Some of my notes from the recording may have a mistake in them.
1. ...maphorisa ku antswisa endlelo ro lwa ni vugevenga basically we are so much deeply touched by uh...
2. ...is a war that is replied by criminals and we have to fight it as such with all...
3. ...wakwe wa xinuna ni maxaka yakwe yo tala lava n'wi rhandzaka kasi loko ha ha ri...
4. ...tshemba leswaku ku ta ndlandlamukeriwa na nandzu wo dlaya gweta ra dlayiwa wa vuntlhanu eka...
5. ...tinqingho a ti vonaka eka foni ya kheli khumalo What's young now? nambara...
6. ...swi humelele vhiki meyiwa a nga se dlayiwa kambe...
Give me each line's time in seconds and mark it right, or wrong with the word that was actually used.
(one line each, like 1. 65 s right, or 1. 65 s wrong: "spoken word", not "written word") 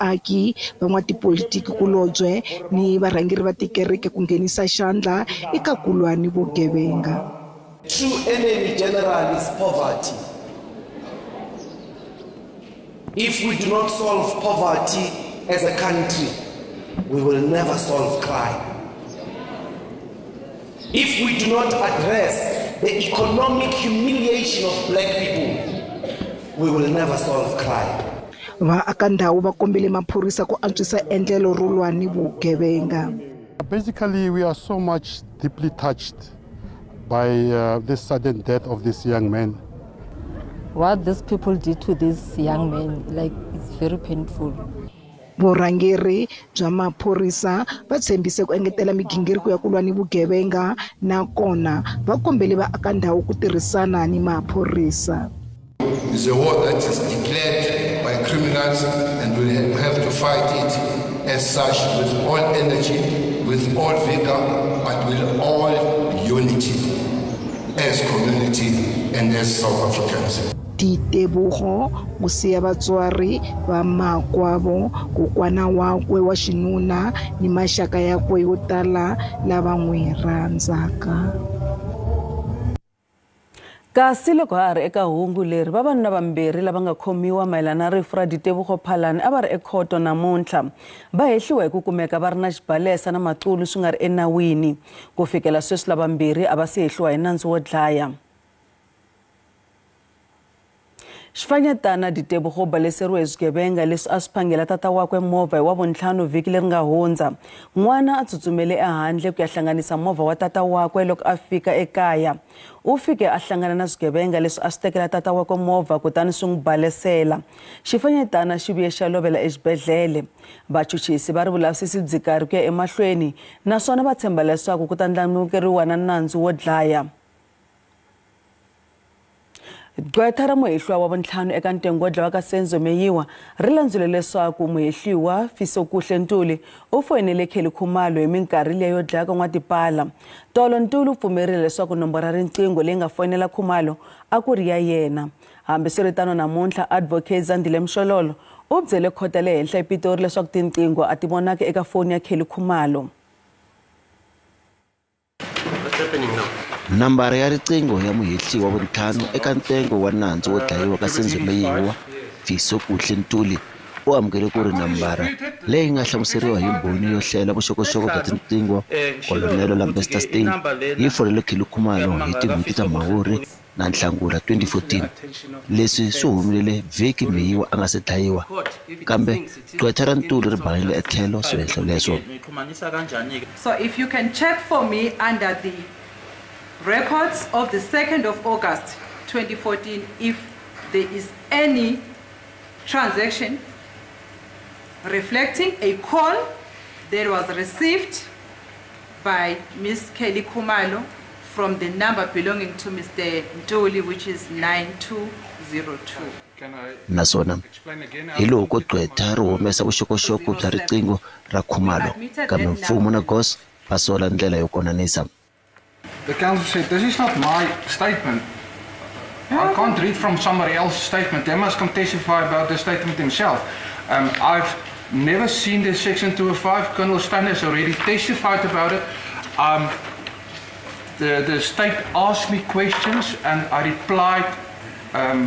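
1. 29 s right
2. 56 s wrong: "declared", not "replied"
3. 75 s right
4. 124 s wrong: "muhehliwa", not "dlayiwa"
5. 150 s wrong: "happening", not "young"
6. 176 s right.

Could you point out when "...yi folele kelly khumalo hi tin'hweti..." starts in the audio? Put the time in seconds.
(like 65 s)
170 s.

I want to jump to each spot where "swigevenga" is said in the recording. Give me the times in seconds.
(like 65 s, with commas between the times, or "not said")
103 s, 113 s.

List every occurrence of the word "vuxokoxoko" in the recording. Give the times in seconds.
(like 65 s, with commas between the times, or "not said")
167 s, 209 s.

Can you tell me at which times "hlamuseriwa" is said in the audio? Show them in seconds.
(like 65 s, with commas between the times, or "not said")
166 s.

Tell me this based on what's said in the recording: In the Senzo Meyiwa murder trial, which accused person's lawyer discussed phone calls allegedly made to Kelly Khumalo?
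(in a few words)
Fisokuhle Ntuli.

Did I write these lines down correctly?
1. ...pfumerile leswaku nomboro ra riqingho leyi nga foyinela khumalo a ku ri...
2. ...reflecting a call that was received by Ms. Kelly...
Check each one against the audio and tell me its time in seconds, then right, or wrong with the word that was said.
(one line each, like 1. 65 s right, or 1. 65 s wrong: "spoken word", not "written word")
1. 141 s right
2. 195 s right.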